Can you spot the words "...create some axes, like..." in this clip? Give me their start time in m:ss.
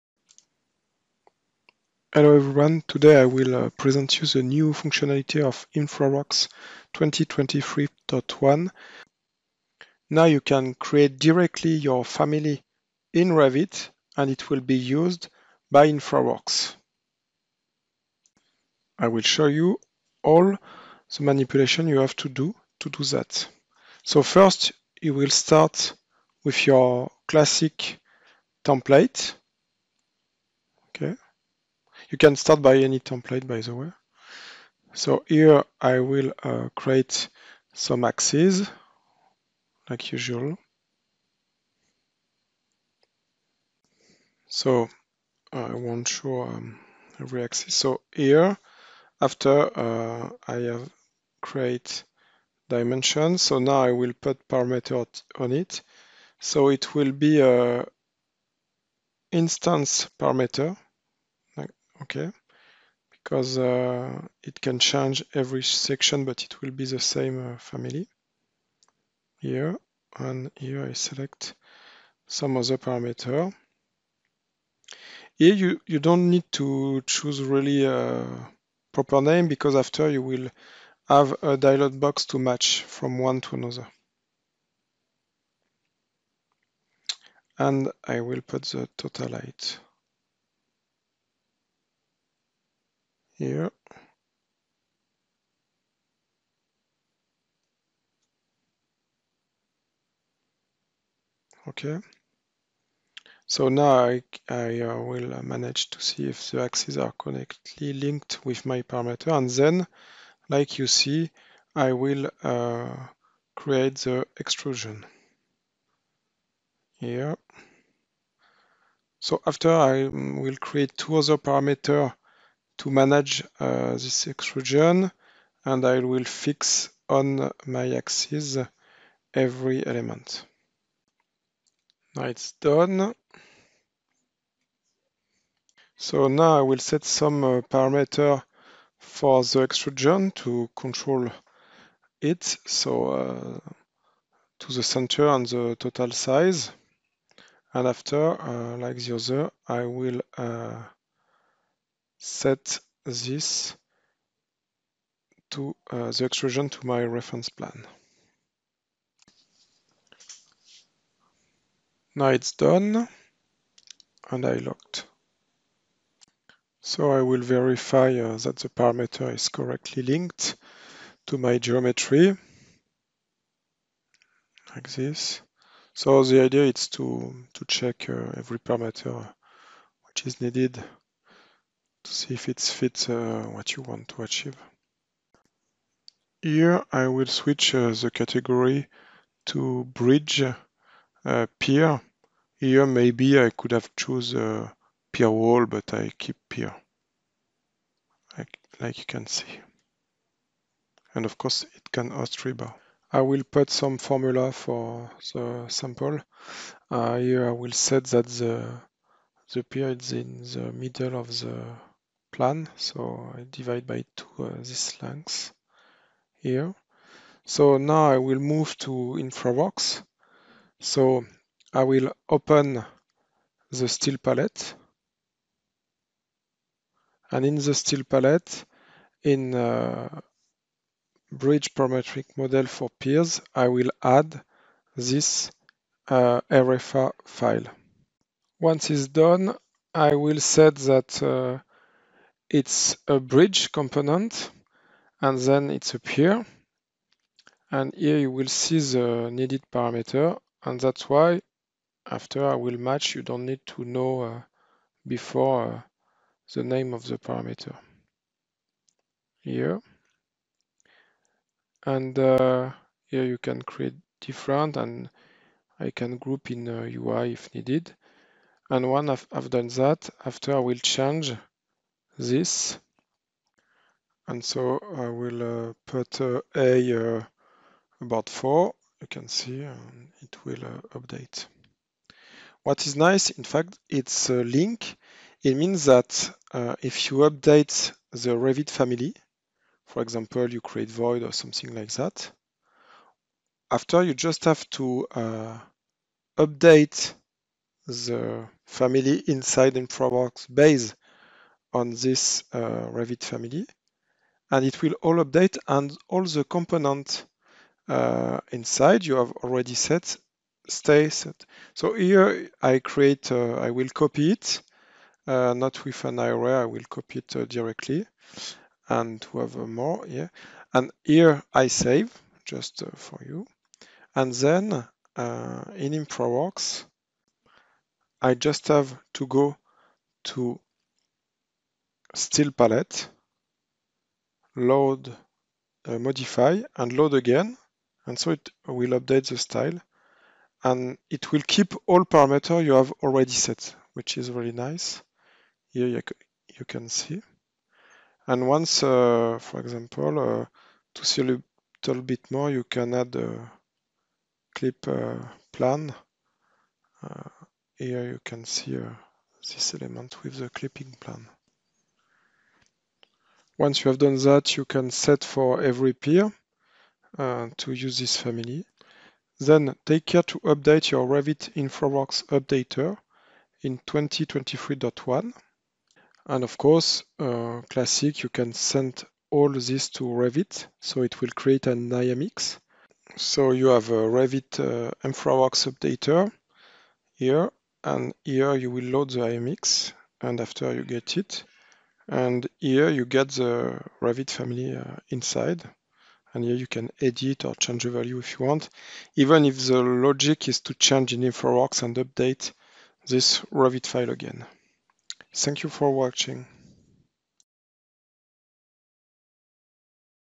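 0:36.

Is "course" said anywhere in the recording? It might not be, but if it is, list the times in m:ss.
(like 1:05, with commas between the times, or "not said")
3:21, 6:16.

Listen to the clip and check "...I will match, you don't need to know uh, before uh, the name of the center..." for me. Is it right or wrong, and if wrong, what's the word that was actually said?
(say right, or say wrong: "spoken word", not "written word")
wrong: "parameter", not "center".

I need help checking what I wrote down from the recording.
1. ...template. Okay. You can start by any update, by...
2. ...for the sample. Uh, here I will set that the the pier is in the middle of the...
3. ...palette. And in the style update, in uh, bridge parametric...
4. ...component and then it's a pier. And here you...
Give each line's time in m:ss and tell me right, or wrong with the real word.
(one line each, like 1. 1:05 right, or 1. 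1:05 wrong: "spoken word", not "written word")
1. 0:28 wrong: "template", not "update"
2. 3:24 right
3. 3:44 wrong: "palette", not "update"
4. 4:03 right.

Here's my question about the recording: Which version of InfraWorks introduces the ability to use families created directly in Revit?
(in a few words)
2023.1.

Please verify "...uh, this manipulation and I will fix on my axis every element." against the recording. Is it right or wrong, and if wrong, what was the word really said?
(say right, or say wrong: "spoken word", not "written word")
wrong: "extrusion", not "manipulation".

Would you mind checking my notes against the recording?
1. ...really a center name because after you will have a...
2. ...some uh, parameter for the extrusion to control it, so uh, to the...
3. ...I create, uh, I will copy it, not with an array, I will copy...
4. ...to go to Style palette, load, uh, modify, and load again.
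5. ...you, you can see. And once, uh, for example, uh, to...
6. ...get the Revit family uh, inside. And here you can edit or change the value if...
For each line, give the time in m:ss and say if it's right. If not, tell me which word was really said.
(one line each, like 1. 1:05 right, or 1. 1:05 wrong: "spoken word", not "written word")
1. 1:17 wrong: "proper", not "center"
2. 2:17 right
3. 5:12 right
4. 5:29 right
5. 5:45 right
6. 6:33 right.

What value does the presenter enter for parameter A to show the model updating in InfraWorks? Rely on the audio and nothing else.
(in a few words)
4.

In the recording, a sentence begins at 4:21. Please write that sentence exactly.
And uh, here you can create different and I can group in UI if needed.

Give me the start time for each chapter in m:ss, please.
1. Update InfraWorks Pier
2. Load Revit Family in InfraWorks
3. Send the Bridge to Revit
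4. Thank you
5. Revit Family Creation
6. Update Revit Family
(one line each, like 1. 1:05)
1. 5:30
2. 3:39
3. 6:08
4. 6:42
5. 0:21
6. 4:42.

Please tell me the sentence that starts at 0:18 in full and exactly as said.
I will show you all the manipulation you have to do to do that.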